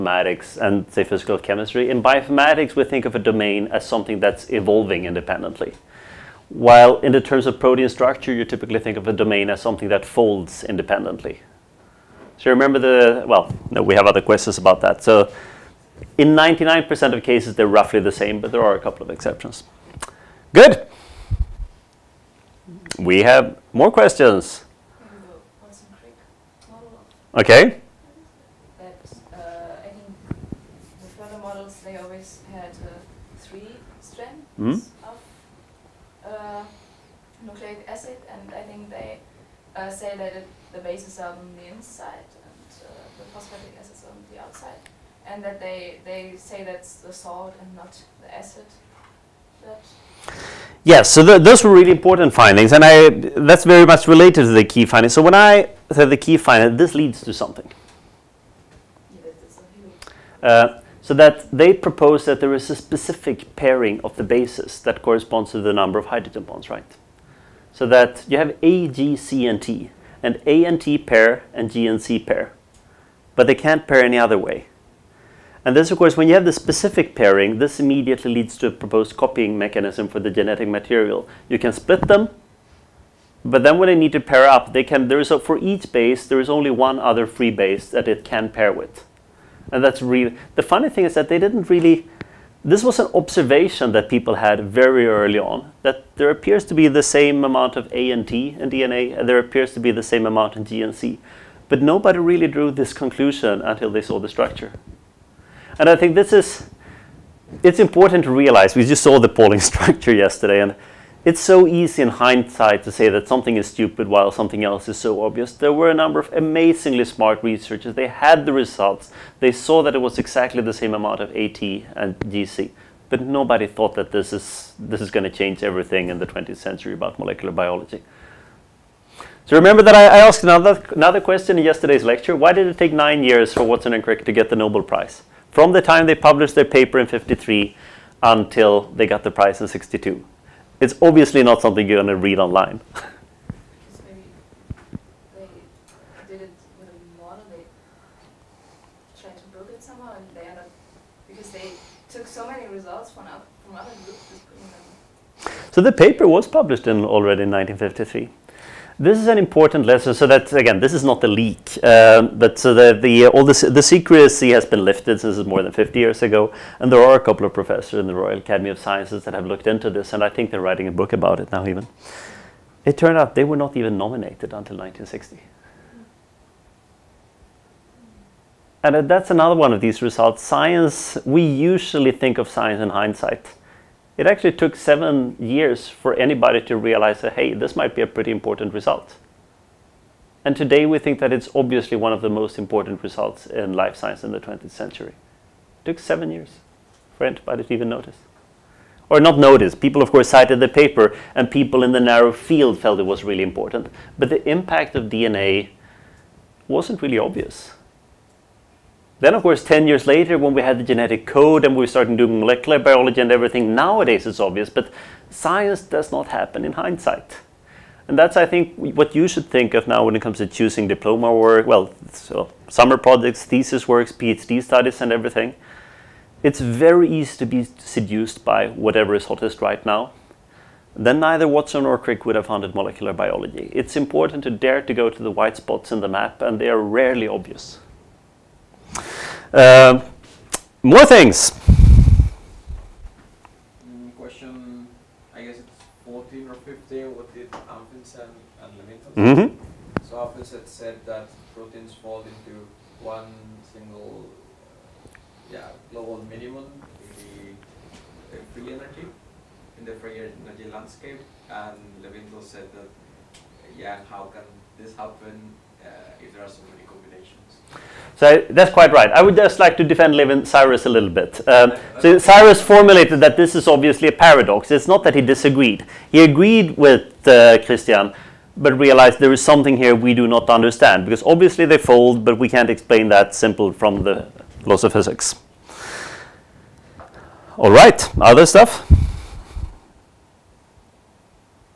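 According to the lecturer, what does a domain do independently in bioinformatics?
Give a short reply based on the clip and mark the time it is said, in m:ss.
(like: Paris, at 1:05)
Evolving, at 0:04.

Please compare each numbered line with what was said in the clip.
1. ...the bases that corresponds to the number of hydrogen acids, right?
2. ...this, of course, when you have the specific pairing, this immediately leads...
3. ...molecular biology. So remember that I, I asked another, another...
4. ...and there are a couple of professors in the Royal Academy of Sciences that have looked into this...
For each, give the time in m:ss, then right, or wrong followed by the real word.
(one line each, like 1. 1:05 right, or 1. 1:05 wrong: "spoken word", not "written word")
1. 1:04 wrong: "bonds", not "acids"
2. 1:15 right
3. 2:07 right
4. 2:46 right.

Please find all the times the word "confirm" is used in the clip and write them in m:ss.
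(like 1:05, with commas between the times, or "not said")
not said.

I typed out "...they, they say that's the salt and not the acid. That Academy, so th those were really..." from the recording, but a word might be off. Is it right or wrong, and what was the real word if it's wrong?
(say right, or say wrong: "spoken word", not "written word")
wrong: "Yes", not "Academy".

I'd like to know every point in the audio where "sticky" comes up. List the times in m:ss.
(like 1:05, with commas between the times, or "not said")
not said.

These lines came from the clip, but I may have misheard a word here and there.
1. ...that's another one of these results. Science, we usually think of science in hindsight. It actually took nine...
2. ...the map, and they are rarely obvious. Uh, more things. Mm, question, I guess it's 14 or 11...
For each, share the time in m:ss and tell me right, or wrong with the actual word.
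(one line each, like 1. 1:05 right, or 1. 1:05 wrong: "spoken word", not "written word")
1. 2:59 wrong: "seven", not "nine"
2. 3:55 wrong: "15", not "11".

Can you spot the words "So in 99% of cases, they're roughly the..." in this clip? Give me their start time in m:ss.
0:15.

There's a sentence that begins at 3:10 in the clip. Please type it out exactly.
And today we think that it's obviously one of the most important results in life science in the 20th century.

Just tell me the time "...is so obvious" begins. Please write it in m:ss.
1:54.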